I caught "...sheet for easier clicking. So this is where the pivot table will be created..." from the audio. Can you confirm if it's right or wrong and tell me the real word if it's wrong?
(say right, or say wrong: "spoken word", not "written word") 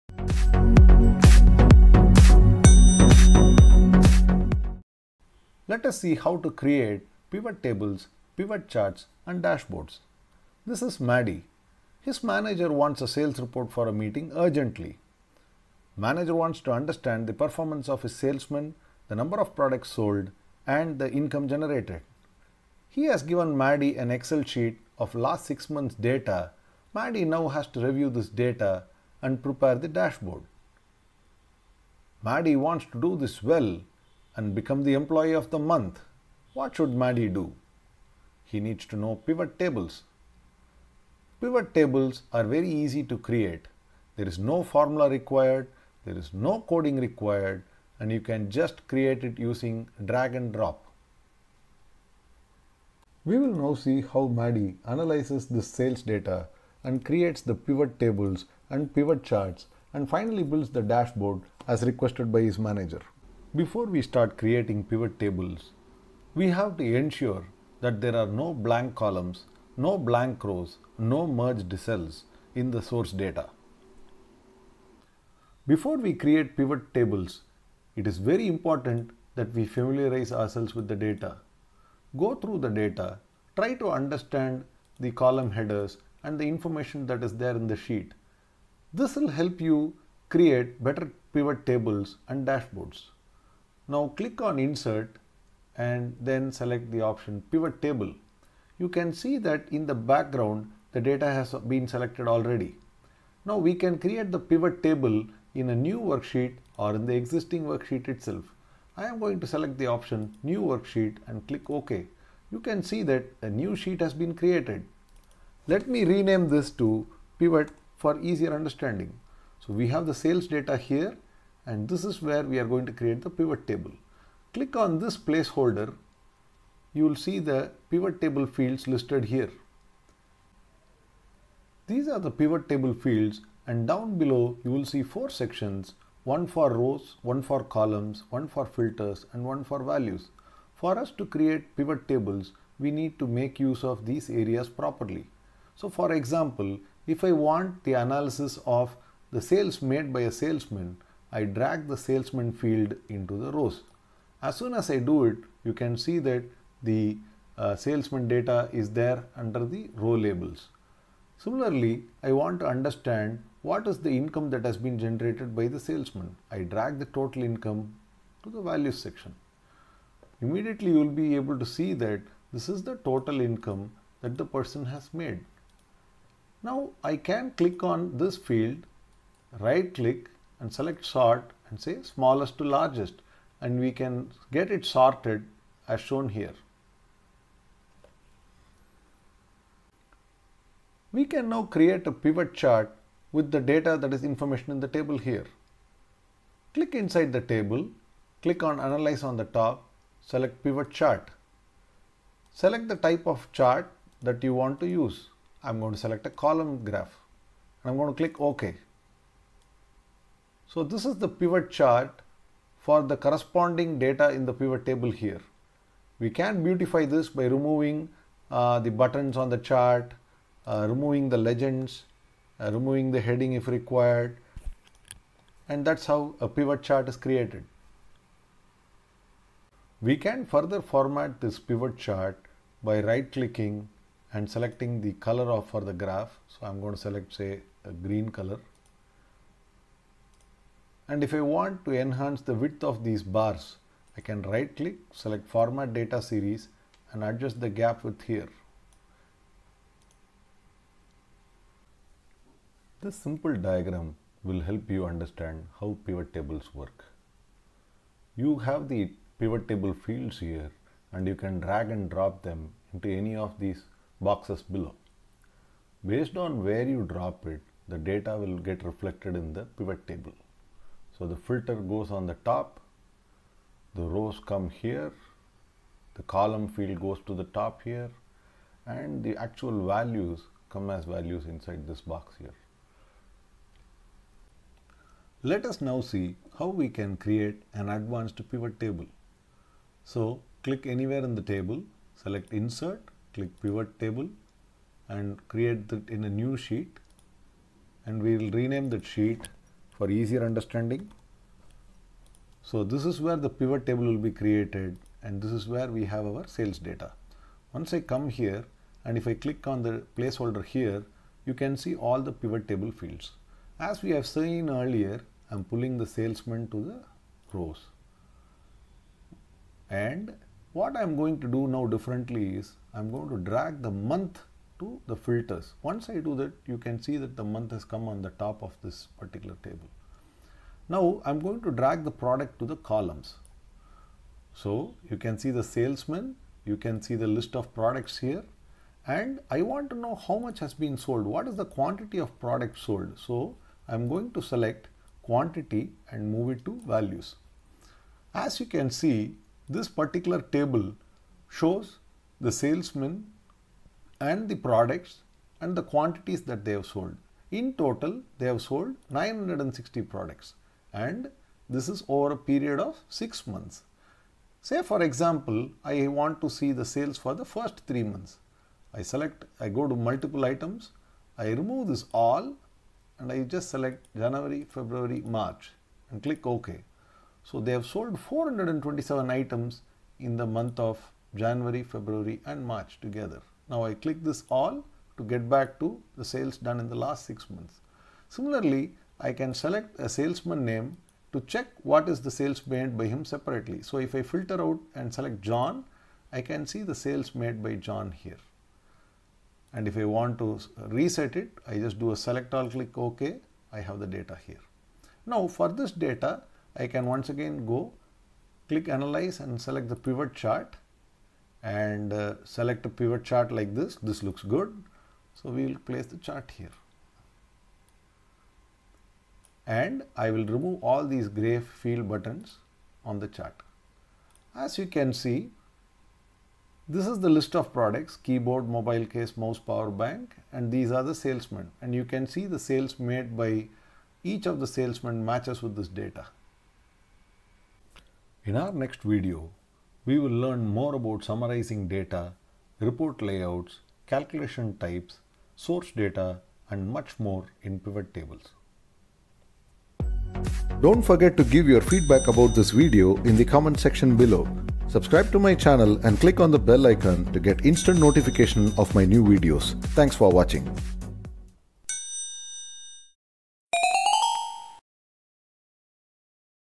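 wrong: "understanding", not "clicking".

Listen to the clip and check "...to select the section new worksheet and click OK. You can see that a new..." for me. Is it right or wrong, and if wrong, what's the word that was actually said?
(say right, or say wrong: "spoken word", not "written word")
wrong: "option", not "section".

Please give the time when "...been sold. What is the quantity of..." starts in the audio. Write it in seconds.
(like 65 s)
340 s.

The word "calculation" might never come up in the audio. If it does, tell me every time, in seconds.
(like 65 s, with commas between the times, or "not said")
444 s.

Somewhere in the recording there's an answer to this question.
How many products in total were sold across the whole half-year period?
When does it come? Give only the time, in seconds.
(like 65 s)
359 s.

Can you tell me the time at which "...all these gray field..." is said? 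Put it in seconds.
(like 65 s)
420 s.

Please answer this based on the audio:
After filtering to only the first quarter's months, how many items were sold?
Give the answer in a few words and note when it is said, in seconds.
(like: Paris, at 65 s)
427, at 378 s.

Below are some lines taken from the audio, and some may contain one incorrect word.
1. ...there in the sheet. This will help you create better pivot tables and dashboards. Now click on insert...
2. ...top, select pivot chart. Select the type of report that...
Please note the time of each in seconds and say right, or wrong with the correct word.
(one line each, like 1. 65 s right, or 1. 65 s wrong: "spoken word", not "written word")
1. 87 s right
2. 199 s wrong: "chart", not "report".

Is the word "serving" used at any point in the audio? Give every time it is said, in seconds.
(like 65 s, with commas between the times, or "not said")
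not said.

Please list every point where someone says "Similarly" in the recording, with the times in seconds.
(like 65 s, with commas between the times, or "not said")
161 s, 388 s.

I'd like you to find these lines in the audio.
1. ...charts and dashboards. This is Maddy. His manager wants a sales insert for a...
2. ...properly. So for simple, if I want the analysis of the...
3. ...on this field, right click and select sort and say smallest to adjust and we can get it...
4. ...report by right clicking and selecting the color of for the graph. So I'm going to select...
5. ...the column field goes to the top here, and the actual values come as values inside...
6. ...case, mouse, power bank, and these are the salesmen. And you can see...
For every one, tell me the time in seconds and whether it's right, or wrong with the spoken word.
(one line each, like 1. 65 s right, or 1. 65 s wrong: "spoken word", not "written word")
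1. 8 s wrong: "report", not "insert"
2. 144 s wrong: "example", not "simple"
3. 177 s wrong: "largest", not "adjust"
4. 231 s wrong: "chart", not "report"
5. 276 s right
6. 429 s right.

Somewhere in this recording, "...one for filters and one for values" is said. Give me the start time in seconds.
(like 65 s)
138 s.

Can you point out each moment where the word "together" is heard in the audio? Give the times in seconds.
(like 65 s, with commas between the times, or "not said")
383 s.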